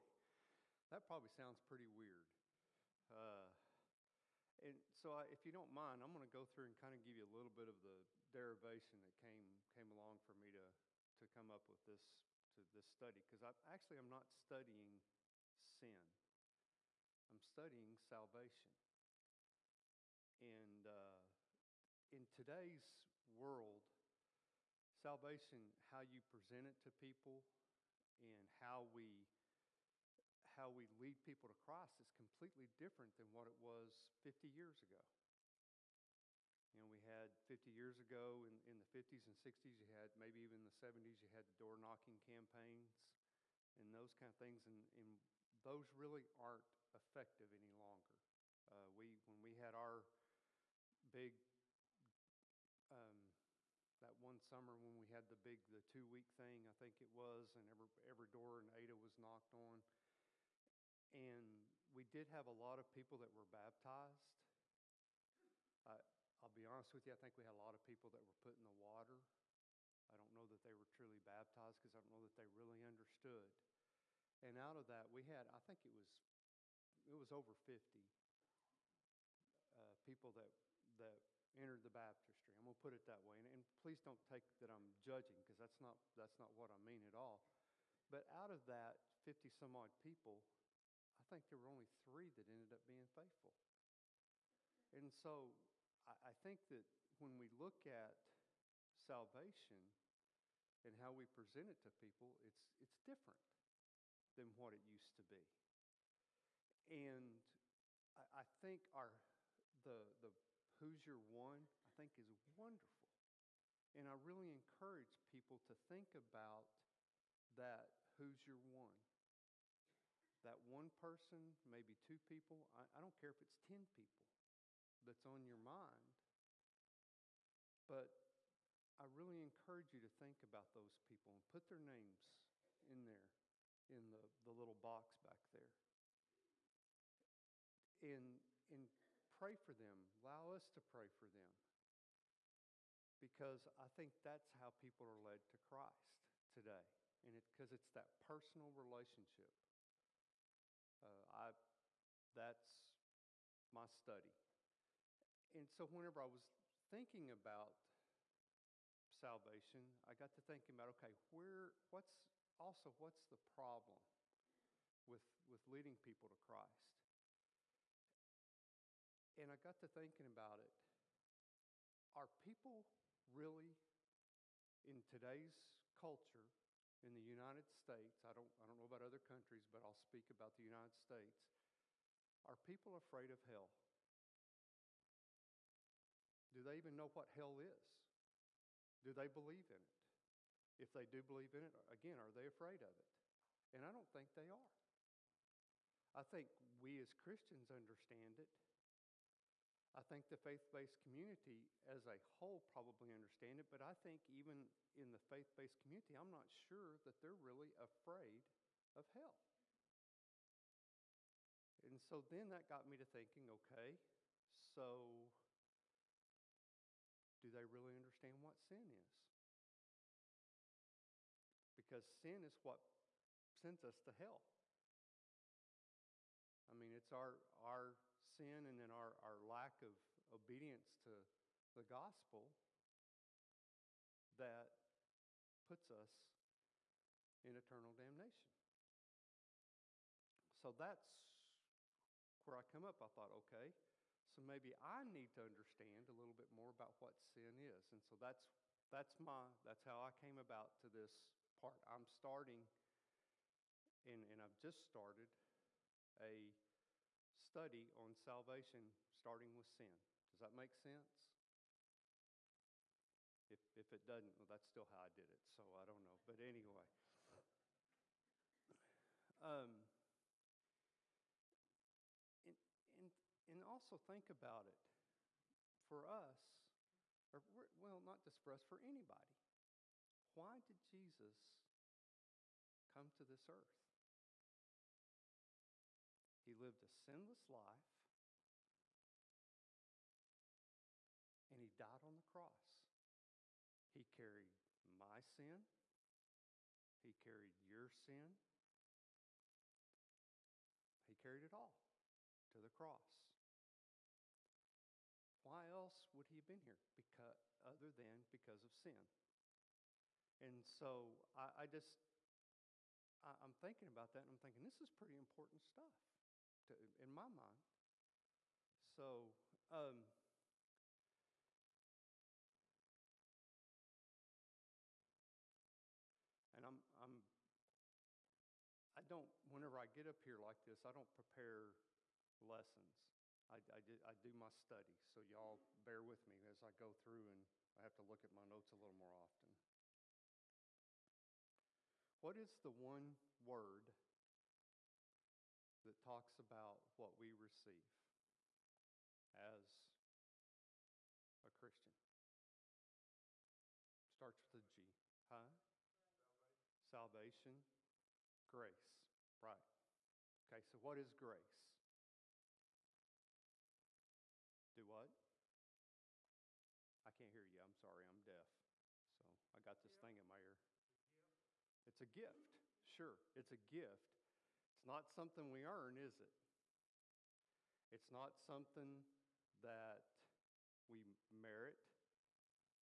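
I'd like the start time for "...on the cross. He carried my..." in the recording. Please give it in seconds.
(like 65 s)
292 s.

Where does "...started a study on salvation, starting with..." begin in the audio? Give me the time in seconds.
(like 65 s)
254 s.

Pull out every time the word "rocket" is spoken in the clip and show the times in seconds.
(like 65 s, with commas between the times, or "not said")
not said.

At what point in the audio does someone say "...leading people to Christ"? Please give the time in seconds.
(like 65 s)
165 s.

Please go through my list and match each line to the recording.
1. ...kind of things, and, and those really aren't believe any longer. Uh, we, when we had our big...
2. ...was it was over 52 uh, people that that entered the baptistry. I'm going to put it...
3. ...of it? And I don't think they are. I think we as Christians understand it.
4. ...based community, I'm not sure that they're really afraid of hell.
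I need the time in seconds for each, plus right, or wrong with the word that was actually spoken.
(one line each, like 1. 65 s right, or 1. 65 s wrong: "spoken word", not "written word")
1. 44 s wrong: "effective", not "believe"
2. 75 s wrong: "50", not "52"
3. 192 s right
4. 205 s right.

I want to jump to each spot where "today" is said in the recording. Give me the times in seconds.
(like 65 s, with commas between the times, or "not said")
22 s, 146 s, 175 s.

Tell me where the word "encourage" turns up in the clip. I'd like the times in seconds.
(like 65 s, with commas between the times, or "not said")
114 s, 129 s.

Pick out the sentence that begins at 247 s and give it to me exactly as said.
And so that's that's my that's how I came about to this part.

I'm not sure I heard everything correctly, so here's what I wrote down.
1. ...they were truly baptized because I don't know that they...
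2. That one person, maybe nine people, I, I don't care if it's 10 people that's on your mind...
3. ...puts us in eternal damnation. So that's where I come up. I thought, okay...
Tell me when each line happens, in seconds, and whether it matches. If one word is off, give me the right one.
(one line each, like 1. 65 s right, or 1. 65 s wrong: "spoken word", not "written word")
1. 70 s right
2. 120 s wrong: "two", not "nine"
3. 235 s right.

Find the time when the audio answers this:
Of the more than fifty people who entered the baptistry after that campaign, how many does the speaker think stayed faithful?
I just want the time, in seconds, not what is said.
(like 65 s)
91 s.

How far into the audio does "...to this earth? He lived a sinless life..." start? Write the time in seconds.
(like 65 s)
283 s.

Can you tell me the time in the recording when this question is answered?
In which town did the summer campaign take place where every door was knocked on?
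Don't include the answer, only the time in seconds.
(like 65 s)
57 s.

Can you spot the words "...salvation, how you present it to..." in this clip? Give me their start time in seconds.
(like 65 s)
25 s.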